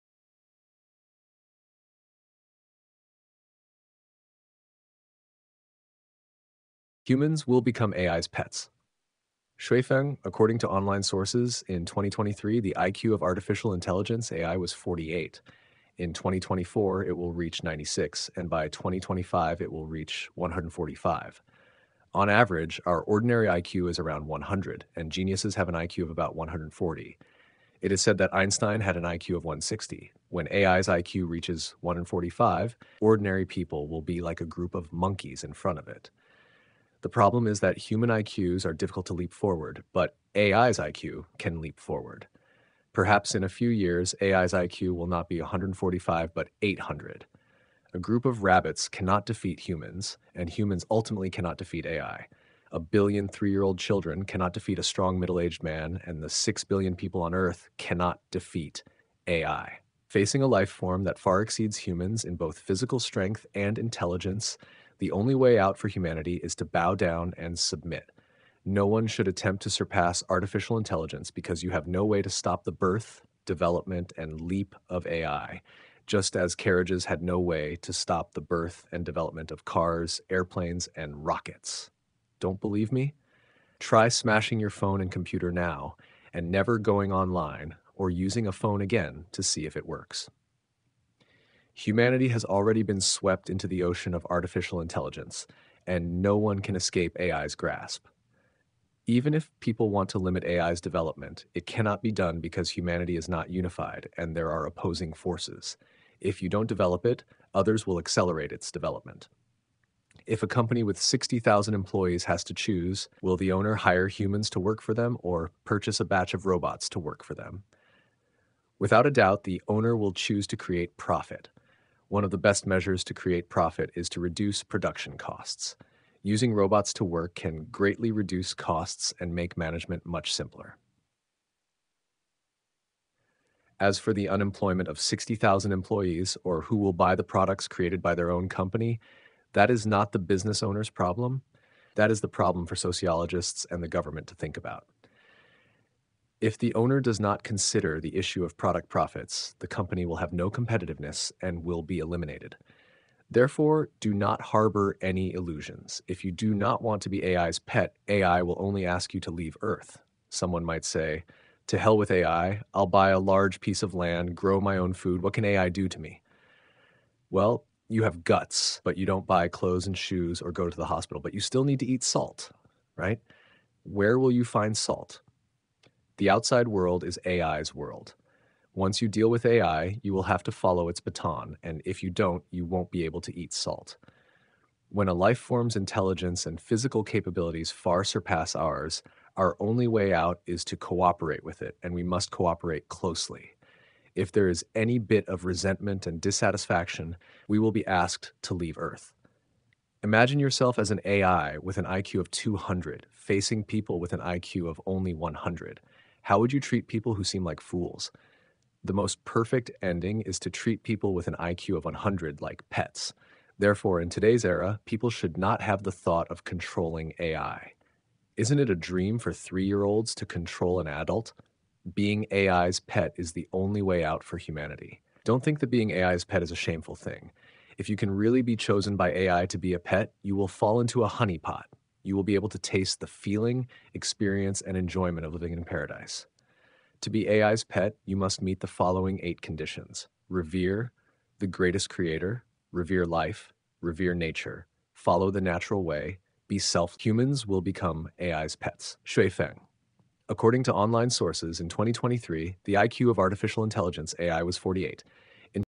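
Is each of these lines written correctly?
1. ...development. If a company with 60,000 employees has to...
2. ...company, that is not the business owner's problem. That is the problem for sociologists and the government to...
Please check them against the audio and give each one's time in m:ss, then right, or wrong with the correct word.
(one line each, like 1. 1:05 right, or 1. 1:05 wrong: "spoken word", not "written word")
1. 1:48 right
2. 2:18 right.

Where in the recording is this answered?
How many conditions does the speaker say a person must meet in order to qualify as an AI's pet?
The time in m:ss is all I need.
3:59.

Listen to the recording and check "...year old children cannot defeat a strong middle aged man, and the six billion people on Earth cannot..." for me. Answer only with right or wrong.
right.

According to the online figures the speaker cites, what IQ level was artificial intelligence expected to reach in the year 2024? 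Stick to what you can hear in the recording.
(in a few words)
96.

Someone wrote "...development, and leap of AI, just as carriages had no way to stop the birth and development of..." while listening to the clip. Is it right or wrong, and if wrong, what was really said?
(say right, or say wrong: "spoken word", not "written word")
right.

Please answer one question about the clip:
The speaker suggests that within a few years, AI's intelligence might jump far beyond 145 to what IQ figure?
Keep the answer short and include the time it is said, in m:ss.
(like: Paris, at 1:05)
800, at 0:46.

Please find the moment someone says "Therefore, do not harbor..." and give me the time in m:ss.
2:33.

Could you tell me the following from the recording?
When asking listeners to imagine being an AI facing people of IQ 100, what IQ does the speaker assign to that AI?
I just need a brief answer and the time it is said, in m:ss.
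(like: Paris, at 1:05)
200, at 3:22.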